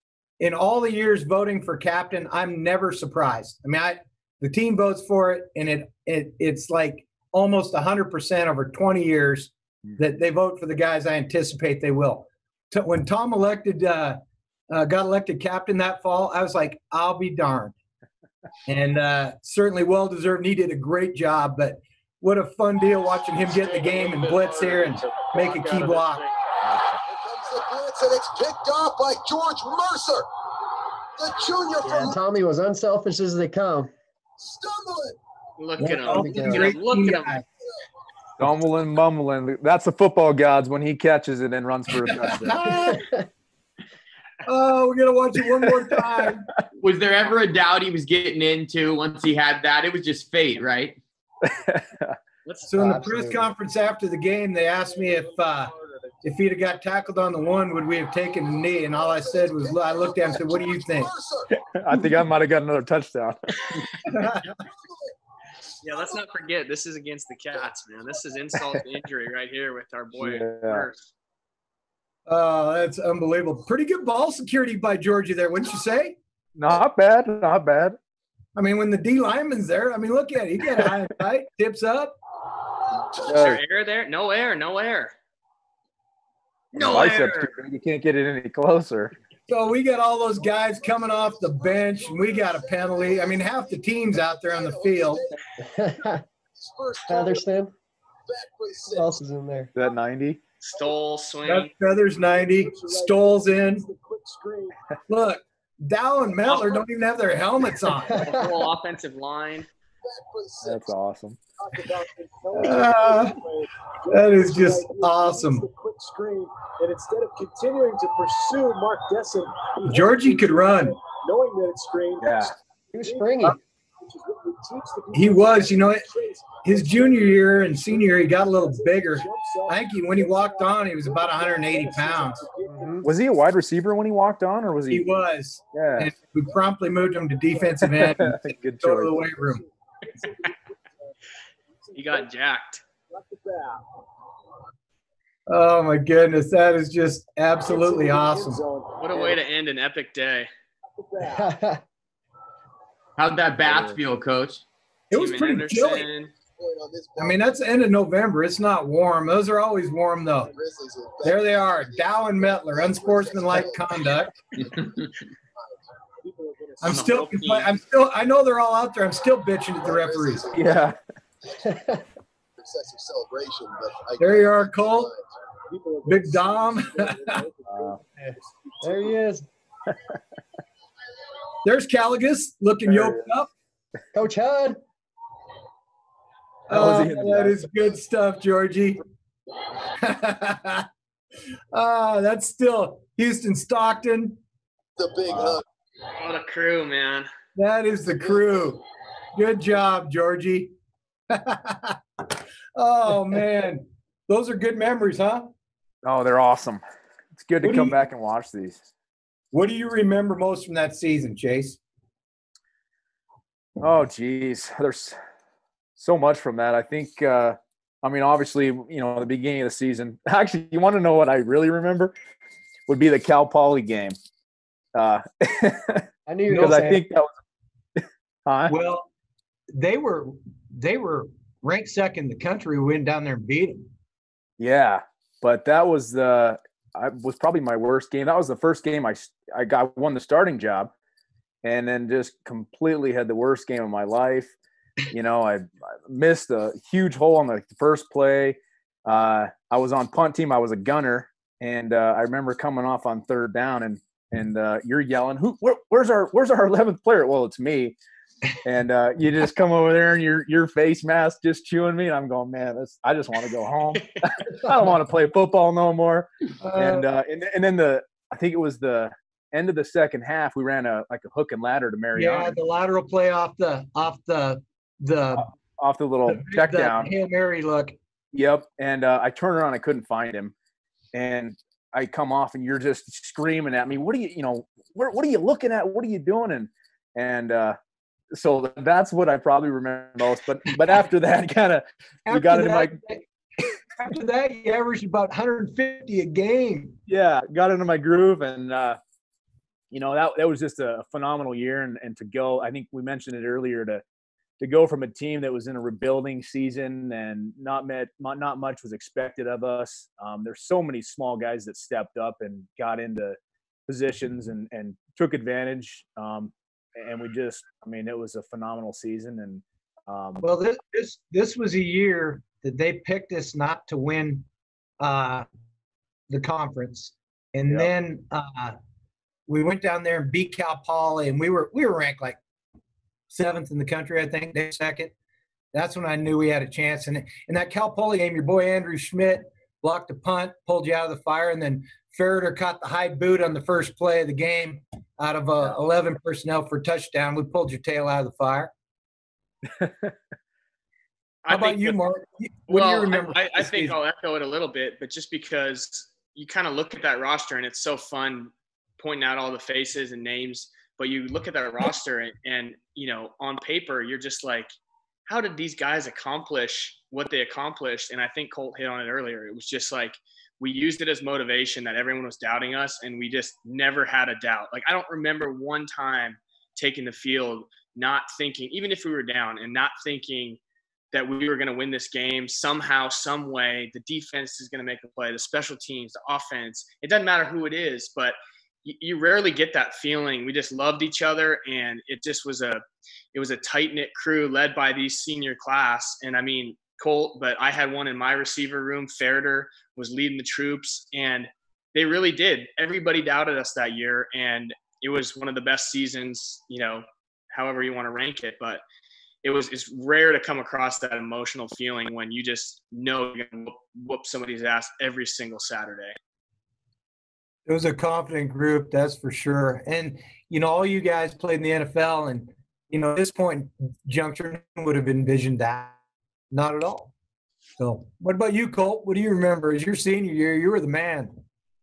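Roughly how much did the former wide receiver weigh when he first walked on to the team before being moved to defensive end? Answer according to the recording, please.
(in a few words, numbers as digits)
180 pounds.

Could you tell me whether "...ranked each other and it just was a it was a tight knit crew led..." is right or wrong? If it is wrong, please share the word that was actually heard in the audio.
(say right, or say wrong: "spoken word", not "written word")
wrong: "loved", not "ranked".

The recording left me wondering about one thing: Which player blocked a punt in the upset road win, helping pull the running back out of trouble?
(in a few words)
Andrew Schmidt.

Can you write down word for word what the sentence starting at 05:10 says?
Um, there's so many small guys that stepped up and got into positions and and took advantage.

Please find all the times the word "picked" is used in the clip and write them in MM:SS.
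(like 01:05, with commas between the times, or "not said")
00:28, 05:23.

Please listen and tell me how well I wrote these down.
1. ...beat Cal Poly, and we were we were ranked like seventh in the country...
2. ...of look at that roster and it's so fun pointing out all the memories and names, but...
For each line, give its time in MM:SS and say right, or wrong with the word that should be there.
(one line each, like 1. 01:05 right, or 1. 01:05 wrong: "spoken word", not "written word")
1. 05:30 right
2. 05:56 wrong: "faces", not "memories".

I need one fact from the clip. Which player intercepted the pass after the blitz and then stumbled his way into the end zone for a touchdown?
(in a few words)
George Mercer.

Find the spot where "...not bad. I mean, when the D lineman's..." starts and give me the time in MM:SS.
01:17.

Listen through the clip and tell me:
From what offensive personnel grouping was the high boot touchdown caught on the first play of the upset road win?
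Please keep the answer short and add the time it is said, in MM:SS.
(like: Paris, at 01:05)
11 personnel, at 05:45.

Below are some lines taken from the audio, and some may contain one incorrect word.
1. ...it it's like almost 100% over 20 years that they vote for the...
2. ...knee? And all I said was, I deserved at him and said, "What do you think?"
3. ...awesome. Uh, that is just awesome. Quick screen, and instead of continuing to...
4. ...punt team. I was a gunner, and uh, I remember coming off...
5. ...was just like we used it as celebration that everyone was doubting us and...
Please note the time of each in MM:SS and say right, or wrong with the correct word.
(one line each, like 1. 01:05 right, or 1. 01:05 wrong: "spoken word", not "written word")
1. 00:06 right
2. 00:58 wrong: "looked", not "deserved"
3. 01:50 right
4. 04:10 right
5. 06:09 wrong: "motivation", not "celebration".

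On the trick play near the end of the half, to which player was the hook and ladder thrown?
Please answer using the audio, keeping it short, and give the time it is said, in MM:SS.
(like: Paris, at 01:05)
Mariani, at 04:31.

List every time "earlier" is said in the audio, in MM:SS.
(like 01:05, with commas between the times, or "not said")
05:03, 06:09.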